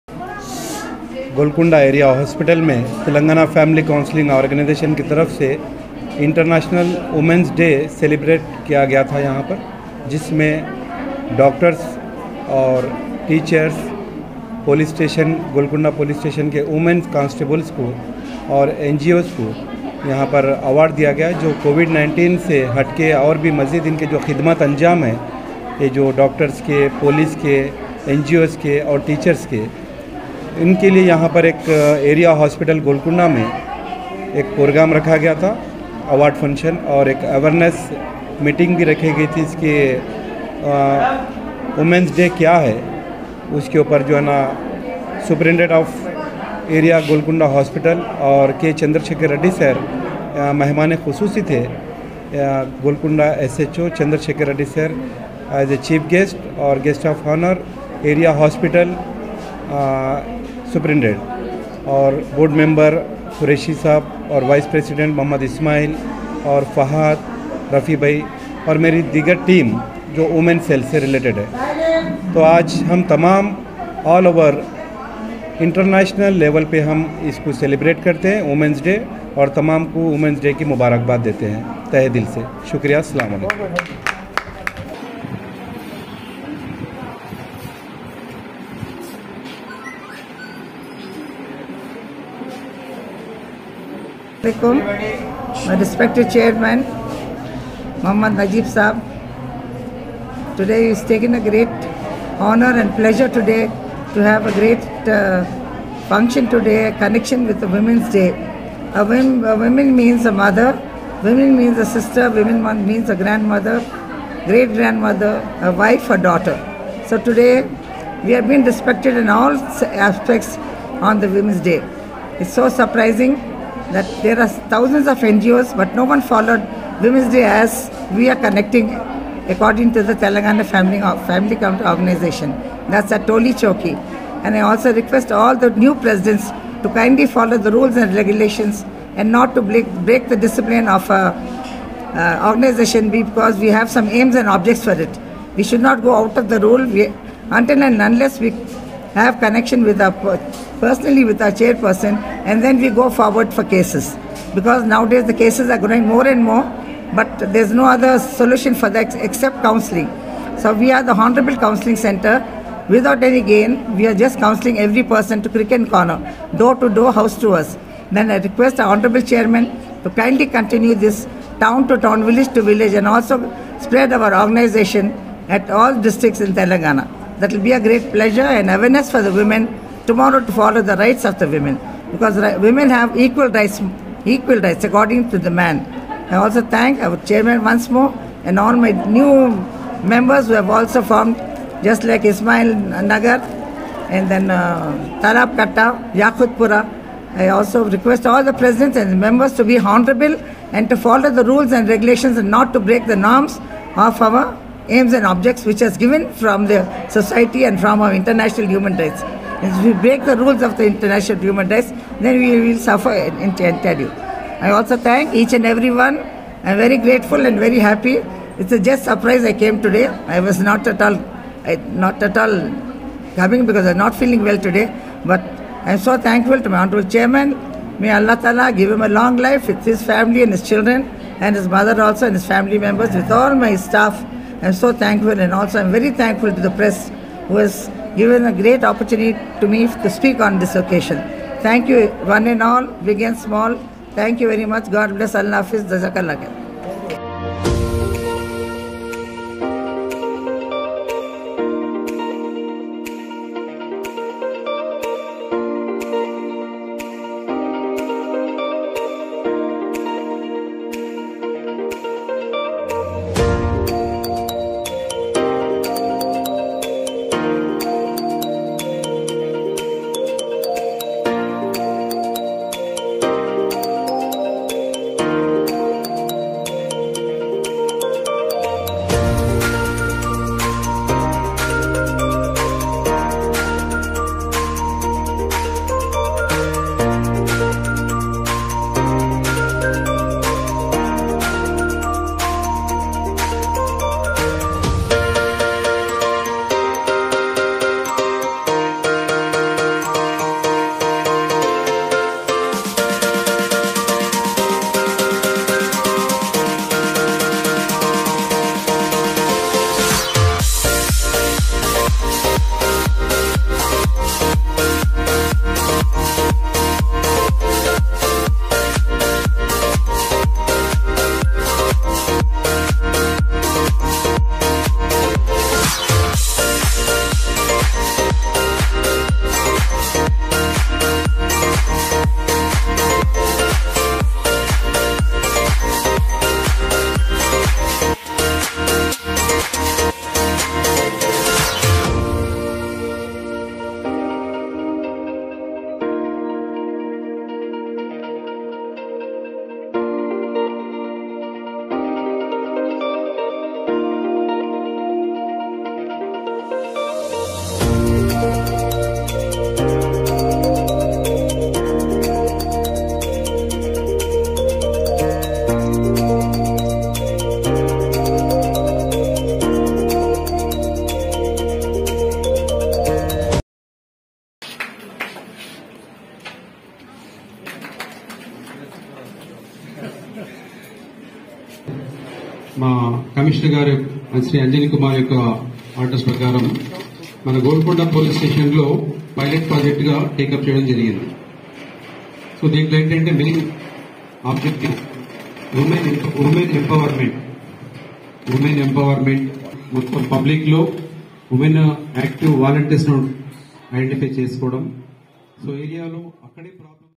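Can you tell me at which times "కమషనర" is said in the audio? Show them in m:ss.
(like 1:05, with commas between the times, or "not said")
6:23.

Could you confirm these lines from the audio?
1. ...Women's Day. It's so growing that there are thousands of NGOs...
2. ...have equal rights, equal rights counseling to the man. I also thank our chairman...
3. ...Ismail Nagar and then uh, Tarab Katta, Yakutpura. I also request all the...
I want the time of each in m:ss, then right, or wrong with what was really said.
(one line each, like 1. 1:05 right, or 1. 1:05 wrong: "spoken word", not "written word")
1. 2:01 wrong: "surprising", not "growing"
2. 3:02 wrong: "according", not "counseling"
3. 3:12 right.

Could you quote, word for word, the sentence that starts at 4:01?
Thank you one and all, big and small.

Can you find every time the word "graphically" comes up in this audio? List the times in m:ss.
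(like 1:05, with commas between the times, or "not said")
not said.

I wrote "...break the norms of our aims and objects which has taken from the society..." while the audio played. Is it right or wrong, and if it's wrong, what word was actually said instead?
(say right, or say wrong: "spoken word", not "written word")
wrong: "given", not "taken".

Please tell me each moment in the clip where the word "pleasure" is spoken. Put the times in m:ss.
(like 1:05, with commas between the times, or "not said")
1:42, 2:58.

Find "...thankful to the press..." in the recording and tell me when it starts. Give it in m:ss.
3:56.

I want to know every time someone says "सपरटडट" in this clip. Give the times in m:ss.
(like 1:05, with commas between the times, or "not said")
0:45, 1:00.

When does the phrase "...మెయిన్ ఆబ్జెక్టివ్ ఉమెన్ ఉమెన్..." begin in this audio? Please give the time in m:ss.
6:33.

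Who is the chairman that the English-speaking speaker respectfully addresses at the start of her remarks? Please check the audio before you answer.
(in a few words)
Muhammad Najib.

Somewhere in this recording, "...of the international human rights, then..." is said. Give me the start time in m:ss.
3:30.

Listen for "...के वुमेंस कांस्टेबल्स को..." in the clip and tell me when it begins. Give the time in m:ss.
0:16.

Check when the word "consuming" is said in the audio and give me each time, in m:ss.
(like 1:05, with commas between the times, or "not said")
not said.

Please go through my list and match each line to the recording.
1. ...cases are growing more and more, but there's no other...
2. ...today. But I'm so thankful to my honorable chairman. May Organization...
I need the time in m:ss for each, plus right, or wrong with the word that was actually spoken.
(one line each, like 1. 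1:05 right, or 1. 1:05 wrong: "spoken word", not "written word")
1. 2:35 right
2. 3:44 wrong: "Allah", not "Organization".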